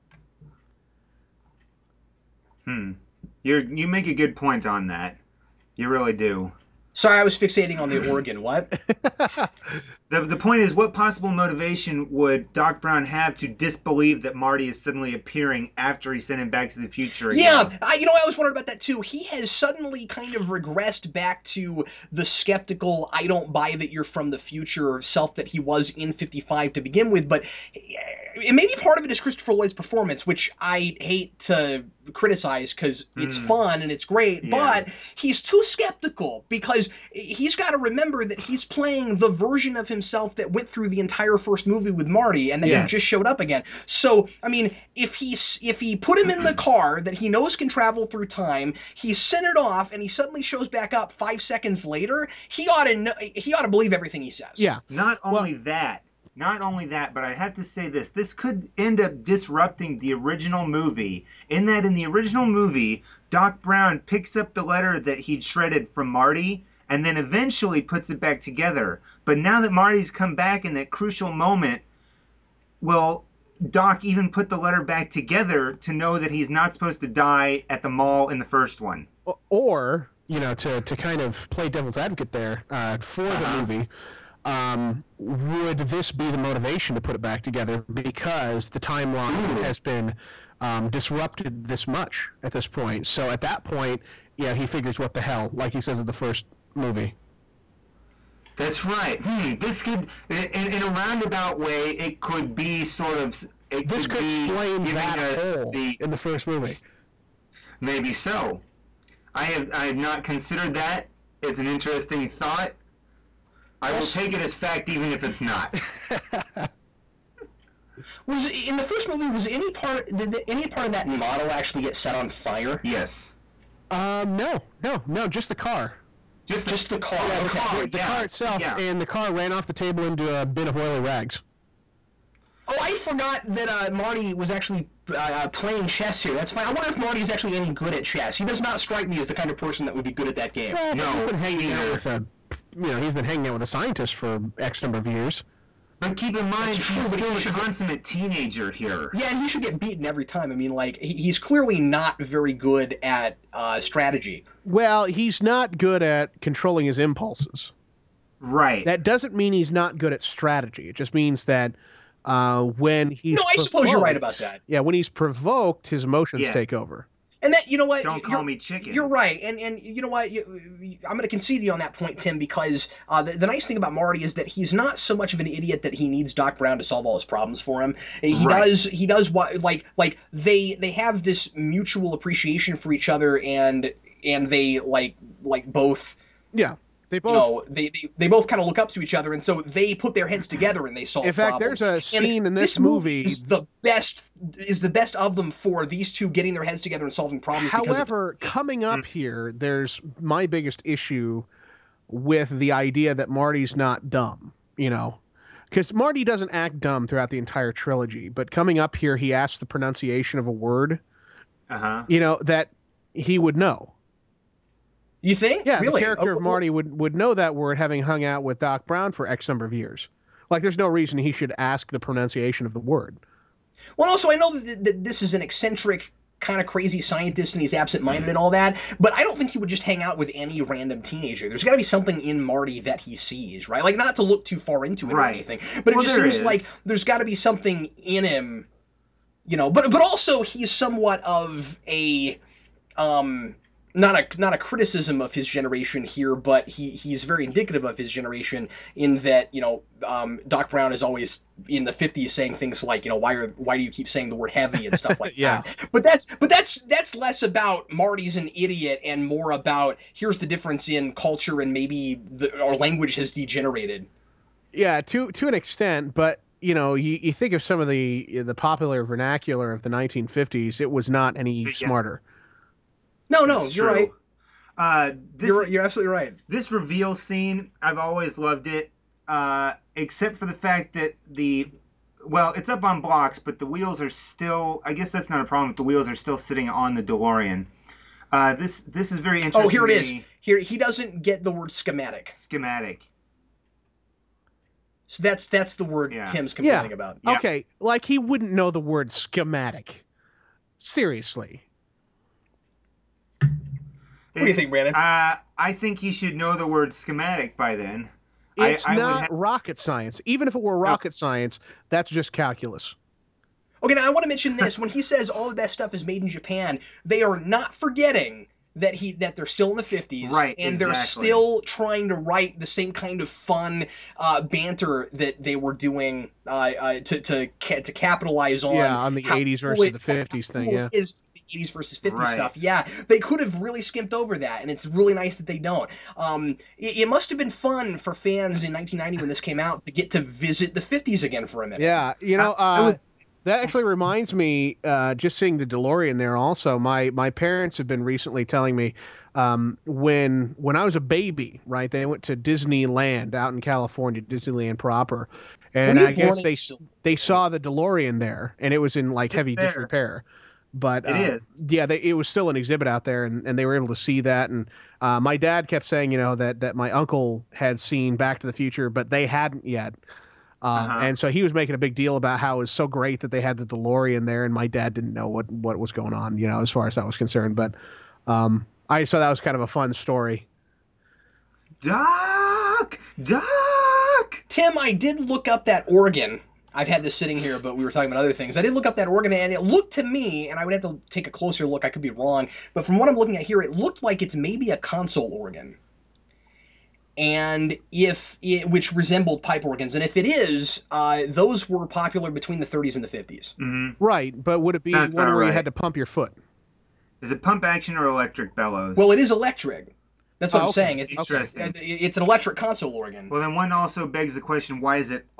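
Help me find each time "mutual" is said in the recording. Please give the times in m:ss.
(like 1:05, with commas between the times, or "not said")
3:01.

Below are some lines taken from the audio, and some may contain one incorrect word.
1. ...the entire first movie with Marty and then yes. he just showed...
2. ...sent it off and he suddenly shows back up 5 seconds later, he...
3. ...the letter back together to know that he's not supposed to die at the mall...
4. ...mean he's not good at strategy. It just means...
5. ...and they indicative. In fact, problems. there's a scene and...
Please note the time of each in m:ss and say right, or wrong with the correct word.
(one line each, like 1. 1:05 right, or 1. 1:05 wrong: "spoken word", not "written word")
1. 0:40 right
2. 0:49 right
3. 1:14 right
4. 2:39 right
5. 3:10 wrong: "solve", not "indicative".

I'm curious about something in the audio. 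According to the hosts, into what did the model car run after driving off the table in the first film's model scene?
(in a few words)
A bin of oily rags.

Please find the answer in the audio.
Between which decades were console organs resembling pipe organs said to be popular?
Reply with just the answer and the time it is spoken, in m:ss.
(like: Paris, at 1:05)
The 30s and the 50s, at 6:42.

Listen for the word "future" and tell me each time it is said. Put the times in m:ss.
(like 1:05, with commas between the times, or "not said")
0:16, 0:24, 6:08.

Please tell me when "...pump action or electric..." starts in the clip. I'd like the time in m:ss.
6:47.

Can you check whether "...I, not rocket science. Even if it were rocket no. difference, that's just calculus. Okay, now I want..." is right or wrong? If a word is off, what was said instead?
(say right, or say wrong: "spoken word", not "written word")
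wrong: "science", not "difference".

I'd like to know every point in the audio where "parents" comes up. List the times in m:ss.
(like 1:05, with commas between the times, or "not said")
5:47.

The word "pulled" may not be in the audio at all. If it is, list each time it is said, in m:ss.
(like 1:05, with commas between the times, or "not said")
not said.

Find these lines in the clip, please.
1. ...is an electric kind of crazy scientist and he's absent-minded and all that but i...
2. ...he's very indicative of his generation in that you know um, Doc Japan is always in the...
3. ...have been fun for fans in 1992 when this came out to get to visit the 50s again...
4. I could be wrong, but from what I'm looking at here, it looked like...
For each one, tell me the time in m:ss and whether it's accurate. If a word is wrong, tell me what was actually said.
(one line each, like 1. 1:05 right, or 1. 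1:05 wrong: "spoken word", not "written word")
1. 3:45 wrong: "eccentric", not "electric"
2. 4:06 wrong: "Brown", not "Japan"
3. 5:37 wrong: "1990", not "1992"
4. 6:31 right.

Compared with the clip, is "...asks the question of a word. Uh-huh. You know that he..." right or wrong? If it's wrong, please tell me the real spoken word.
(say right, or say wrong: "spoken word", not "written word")
wrong: "pronunciation", not "question".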